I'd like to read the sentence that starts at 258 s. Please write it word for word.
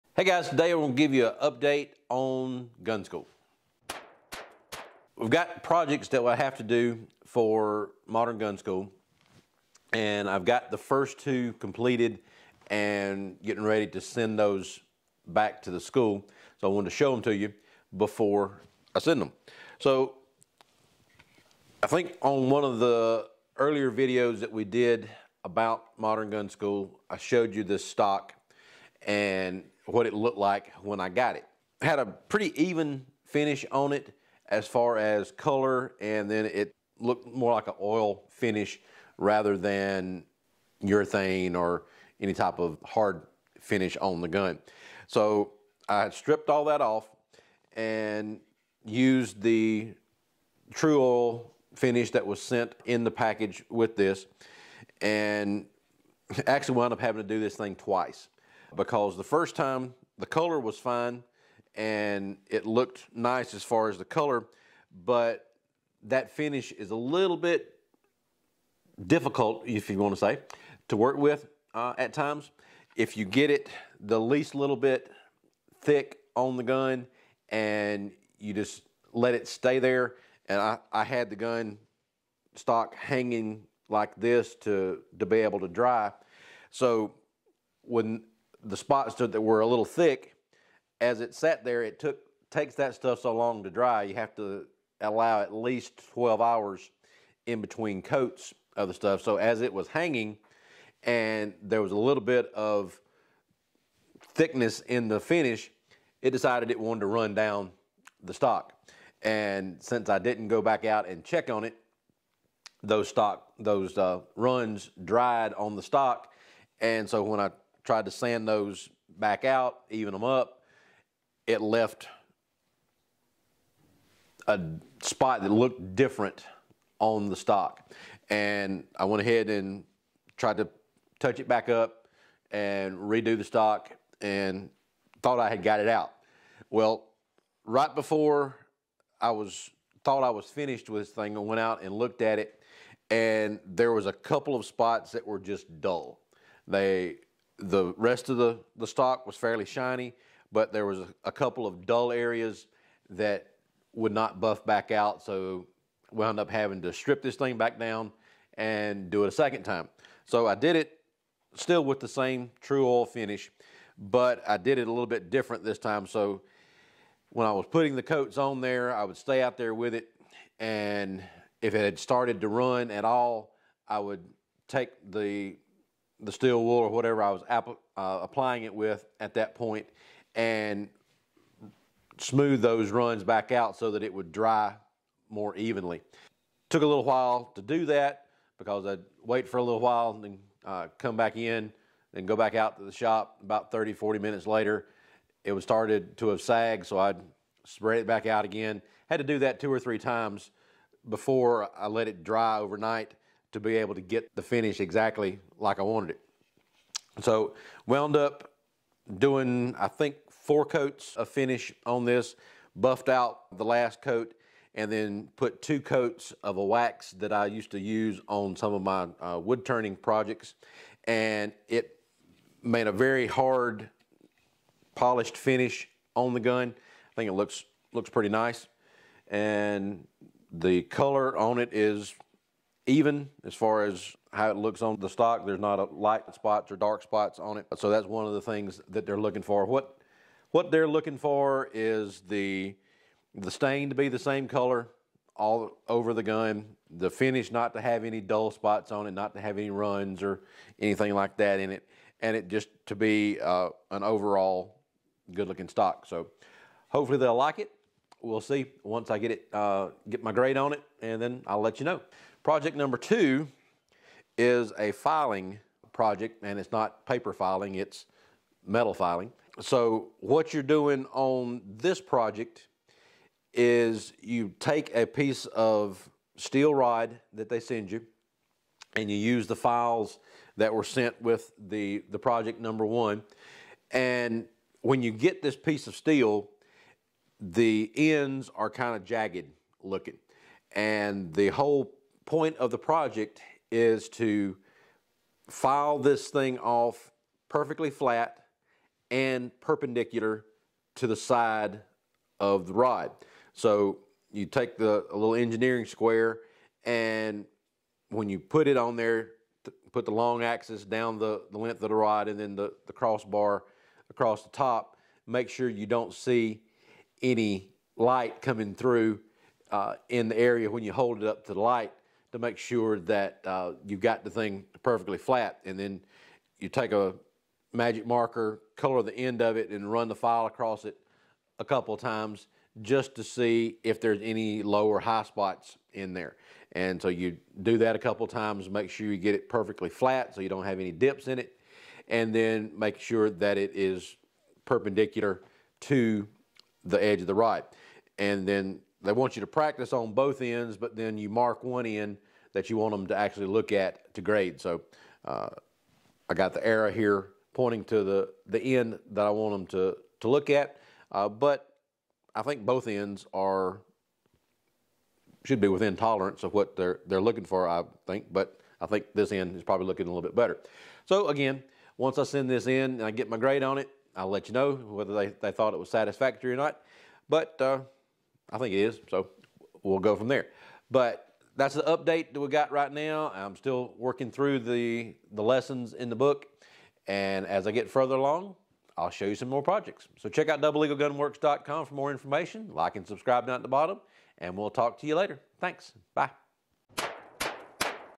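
We'll see once I get it, uh, get my grade on it, and then I'll let you know.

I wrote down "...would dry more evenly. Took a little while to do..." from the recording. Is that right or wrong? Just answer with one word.
right.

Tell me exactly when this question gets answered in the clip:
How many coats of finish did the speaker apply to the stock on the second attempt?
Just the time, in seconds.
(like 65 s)
210 s.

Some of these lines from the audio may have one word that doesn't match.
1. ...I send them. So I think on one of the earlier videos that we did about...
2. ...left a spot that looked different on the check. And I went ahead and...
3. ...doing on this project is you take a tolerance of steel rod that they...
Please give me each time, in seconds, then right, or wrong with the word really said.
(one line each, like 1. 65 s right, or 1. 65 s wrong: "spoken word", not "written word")
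1. 18 s right
2. 121 s wrong: "stock", not "check"
3. 270 s wrong: "piece", not "tolerance".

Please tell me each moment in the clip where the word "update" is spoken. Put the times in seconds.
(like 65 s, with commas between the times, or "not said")
1 s, 381 s.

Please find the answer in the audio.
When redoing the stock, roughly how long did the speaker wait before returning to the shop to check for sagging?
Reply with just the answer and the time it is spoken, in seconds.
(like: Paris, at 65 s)
30 to 40 minutes, at 193 s.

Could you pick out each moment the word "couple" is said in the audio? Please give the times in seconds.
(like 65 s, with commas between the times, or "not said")
144 s, 151 s, 331 s, 337 s.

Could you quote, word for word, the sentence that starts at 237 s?
So that's one of the things that they're looking for.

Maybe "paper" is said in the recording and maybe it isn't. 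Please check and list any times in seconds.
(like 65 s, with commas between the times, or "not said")
267 s.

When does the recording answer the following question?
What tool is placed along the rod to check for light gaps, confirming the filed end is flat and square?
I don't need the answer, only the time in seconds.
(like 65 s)
305 s.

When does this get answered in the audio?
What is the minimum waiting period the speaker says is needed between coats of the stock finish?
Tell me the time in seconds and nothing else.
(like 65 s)
96 s.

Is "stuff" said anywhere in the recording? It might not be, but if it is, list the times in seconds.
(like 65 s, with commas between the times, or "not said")
92 s, 98 s.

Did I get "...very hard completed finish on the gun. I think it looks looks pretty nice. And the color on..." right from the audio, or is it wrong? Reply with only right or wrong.
wrong.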